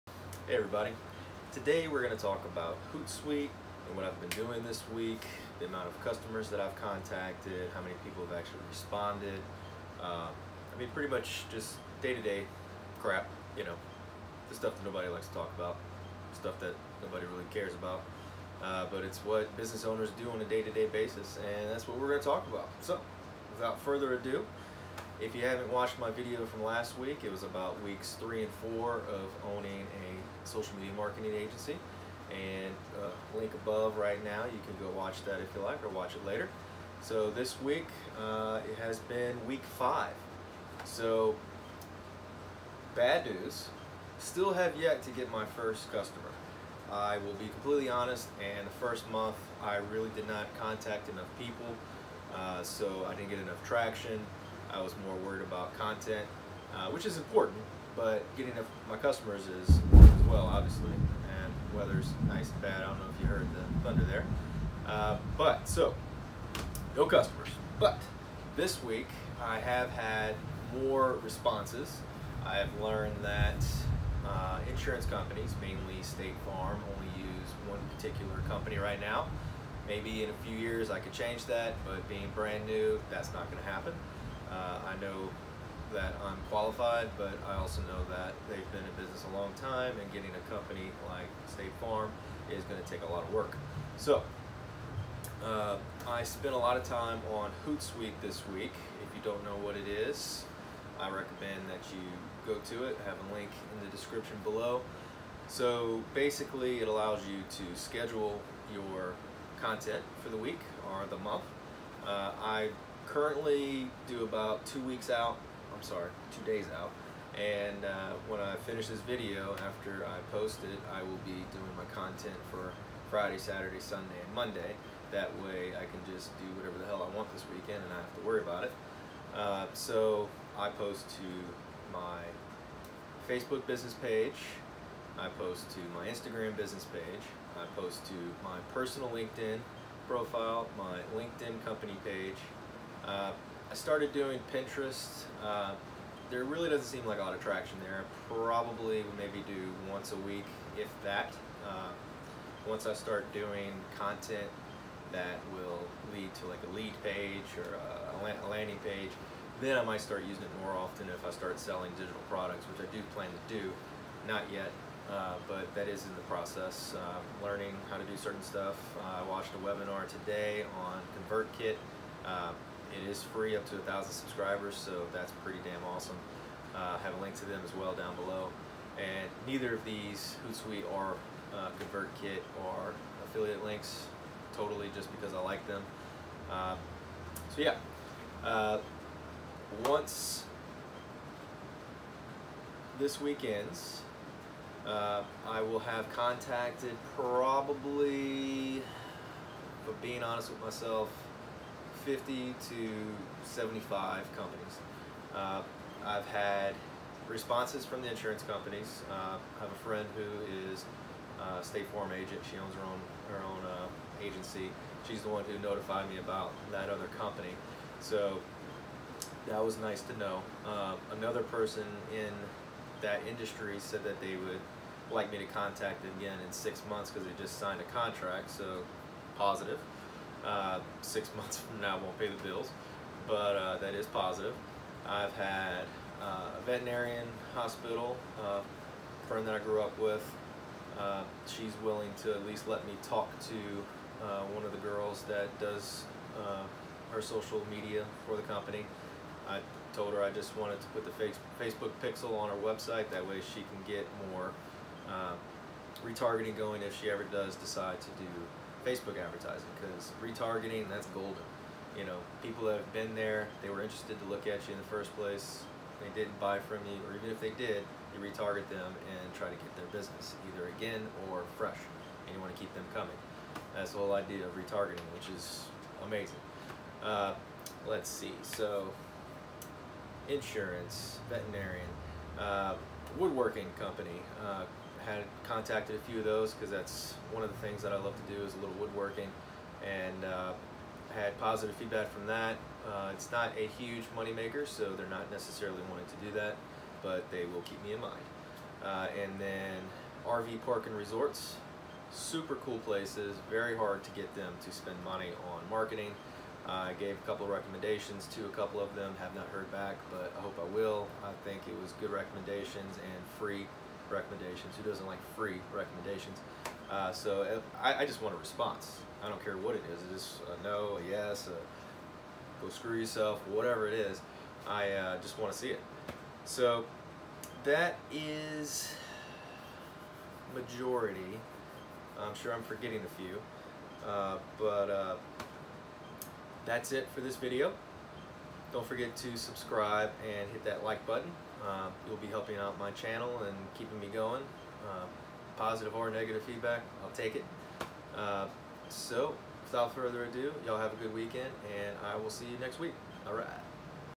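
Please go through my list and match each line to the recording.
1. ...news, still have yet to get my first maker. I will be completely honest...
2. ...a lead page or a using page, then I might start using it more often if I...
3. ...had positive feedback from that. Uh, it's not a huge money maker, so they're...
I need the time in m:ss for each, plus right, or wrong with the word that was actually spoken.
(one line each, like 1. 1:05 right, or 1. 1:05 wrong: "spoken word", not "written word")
1. 0:43 wrong: "customer", not "maker"
2. 2:36 wrong: "landing", not "using"
3. 4:51 right.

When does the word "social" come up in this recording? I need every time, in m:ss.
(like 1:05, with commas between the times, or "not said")
0:30, 4:07.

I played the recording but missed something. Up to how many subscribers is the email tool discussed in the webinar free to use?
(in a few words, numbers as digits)
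1,000.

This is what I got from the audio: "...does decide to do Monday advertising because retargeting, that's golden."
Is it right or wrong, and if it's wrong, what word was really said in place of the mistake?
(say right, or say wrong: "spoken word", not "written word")
wrong: "Facebook", not "Monday".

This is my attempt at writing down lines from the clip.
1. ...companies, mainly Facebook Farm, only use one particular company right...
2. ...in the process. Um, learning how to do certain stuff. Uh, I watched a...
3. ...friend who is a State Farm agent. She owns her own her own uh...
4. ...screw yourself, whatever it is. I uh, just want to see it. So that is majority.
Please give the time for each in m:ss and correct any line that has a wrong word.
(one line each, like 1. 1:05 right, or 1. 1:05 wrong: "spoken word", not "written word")
1. 1:15 wrong: "State", not "Facebook"
2. 2:46 right
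3. 3:29 right
4. 5:22 right.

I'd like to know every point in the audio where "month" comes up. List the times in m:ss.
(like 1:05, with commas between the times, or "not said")
0:49, 1:51, 3:46, 3:51.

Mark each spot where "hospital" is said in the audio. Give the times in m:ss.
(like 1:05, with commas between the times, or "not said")
3:57.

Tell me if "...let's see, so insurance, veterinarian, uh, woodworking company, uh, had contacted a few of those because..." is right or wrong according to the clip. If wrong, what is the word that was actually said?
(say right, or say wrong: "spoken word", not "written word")
right.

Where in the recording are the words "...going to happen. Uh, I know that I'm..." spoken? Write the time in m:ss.
1:23.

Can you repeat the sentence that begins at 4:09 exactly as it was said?
I told her I just wanted to put the Facebook pixel on her website.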